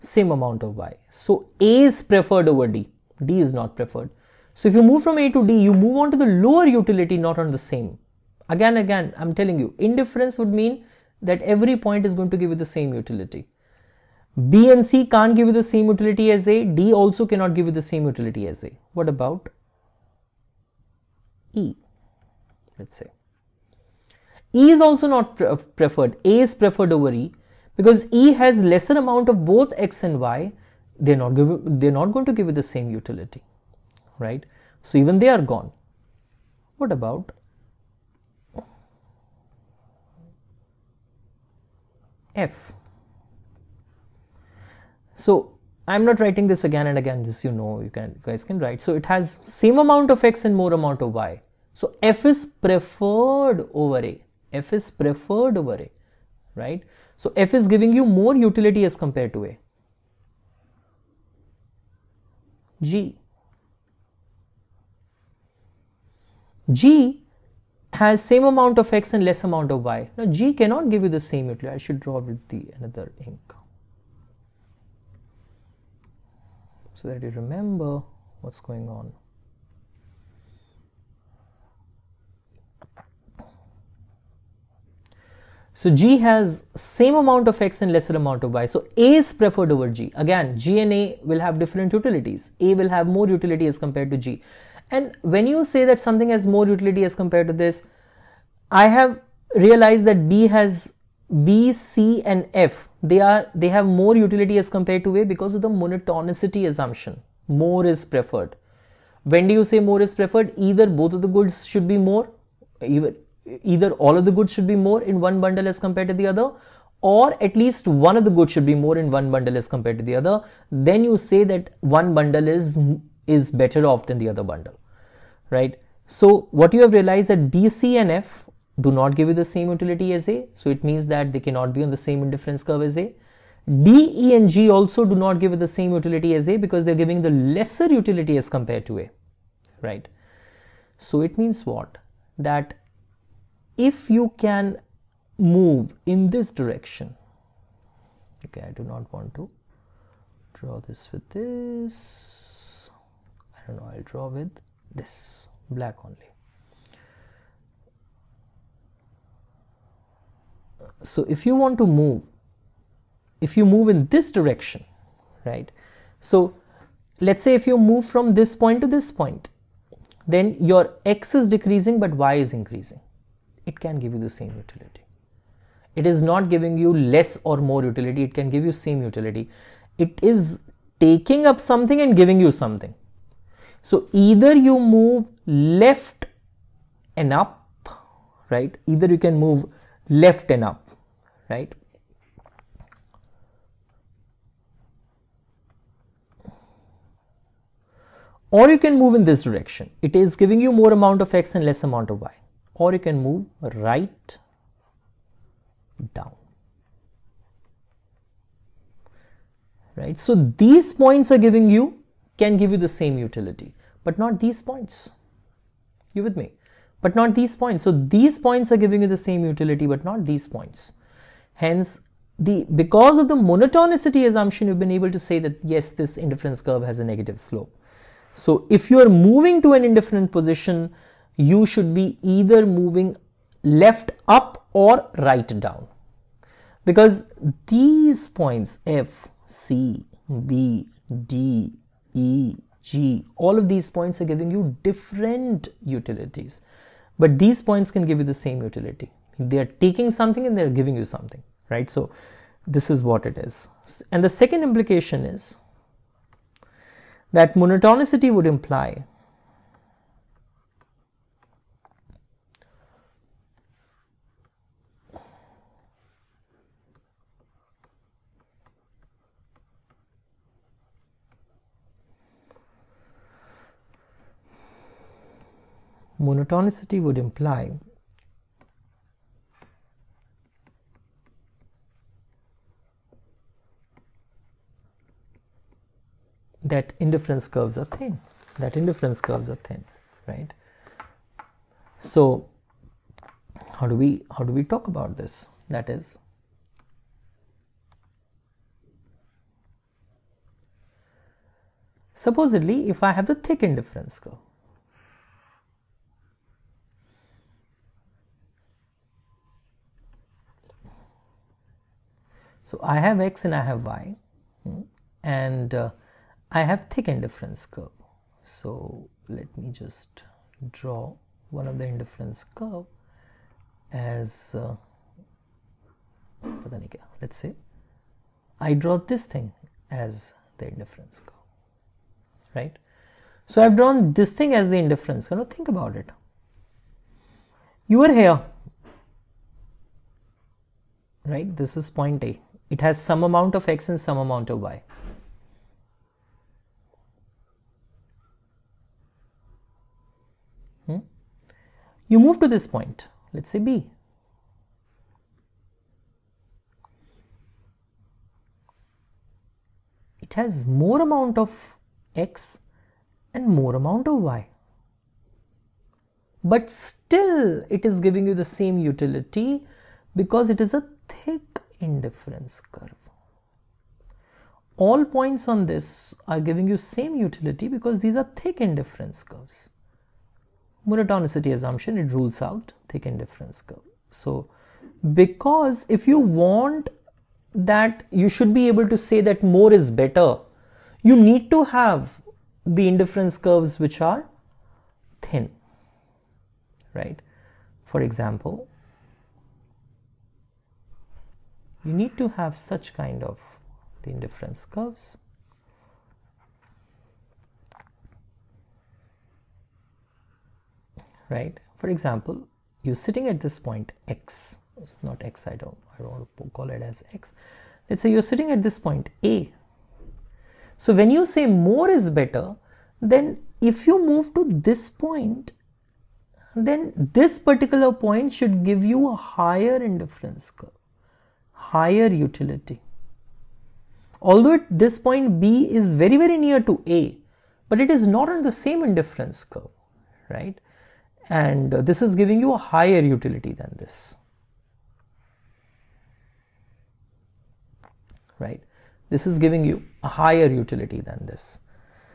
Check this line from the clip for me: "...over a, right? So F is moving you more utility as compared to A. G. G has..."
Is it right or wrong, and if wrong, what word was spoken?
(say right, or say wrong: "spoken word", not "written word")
wrong: "giving", not "moving".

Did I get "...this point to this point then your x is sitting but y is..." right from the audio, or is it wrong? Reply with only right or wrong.
wrong.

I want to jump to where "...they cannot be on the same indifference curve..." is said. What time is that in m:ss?
2:11.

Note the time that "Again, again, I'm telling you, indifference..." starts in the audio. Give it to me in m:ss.
0:08.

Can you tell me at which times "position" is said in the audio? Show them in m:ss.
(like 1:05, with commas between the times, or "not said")
3:50.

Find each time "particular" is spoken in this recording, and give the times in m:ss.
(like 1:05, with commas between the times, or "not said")
7:07.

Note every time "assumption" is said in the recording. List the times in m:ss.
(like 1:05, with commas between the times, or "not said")
1:46, 3:44, 6:21.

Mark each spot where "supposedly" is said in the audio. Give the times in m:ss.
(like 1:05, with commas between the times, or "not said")
5:02.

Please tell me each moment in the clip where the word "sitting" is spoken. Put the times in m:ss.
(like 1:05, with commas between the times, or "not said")
6:53, 6:58.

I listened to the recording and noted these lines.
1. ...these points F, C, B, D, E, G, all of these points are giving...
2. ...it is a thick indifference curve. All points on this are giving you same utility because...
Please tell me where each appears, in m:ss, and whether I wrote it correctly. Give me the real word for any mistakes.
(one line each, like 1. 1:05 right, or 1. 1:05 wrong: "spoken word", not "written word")
1. 3:57 right
2. 6:10 right.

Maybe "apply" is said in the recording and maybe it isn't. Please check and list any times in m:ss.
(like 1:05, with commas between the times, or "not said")
not said.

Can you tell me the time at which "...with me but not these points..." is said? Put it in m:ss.
3:36.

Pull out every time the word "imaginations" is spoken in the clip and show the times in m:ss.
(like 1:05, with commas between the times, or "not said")
not said.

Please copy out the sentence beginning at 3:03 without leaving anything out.
So either you move left and up, right?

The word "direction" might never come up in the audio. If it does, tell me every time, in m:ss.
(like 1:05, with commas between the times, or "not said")
2:26, 2:44, 3:19.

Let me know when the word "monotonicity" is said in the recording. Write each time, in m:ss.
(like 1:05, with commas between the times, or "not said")
1:45, 3:43, 4:17, 4:36, 6:20.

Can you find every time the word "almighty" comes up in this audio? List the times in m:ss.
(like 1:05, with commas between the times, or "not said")
not said.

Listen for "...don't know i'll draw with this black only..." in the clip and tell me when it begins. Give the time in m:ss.
2:33.